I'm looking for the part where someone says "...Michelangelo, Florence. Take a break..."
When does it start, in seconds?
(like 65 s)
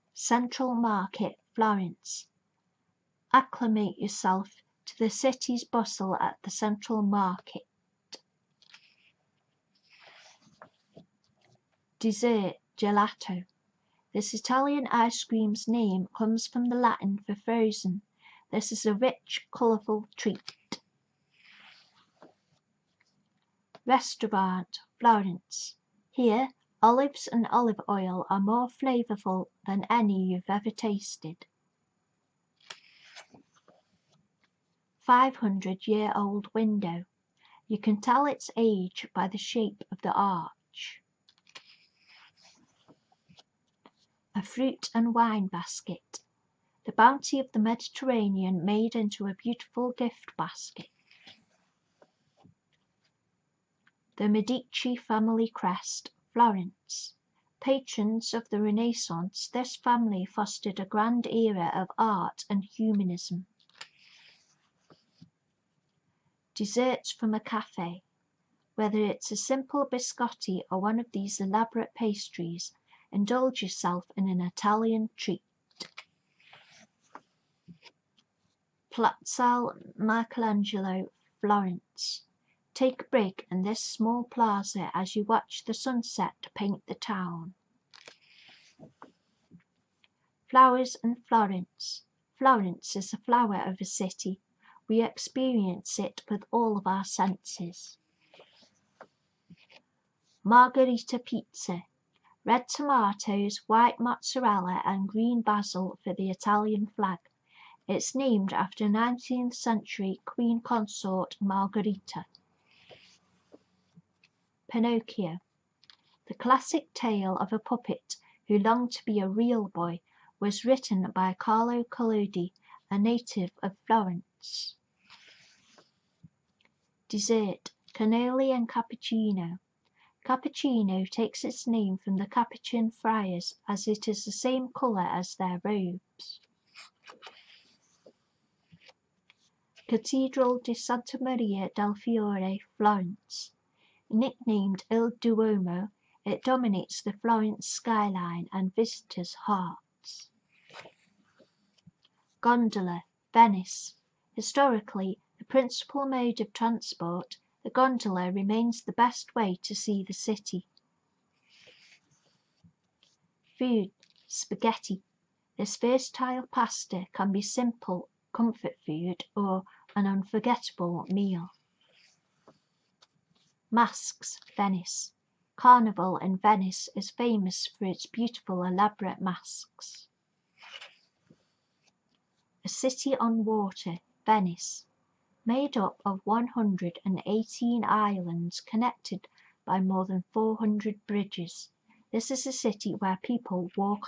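79 s.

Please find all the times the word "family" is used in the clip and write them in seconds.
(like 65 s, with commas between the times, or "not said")
54 s, 59 s.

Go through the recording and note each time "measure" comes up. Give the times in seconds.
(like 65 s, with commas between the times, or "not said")
not said.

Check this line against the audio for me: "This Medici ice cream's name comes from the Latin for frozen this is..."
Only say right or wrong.
wrong.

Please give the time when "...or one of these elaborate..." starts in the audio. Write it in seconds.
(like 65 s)
70 s.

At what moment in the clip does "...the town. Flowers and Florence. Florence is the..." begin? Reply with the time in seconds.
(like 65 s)
86 s.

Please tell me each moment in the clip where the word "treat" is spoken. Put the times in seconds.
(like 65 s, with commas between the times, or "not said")
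20 s, 75 s.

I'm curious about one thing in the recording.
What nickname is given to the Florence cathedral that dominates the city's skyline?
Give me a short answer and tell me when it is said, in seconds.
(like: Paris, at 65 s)
Il Duomo, at 144 s.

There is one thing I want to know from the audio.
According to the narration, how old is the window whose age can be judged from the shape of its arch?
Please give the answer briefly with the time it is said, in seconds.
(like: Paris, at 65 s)
500 years, at 34 s.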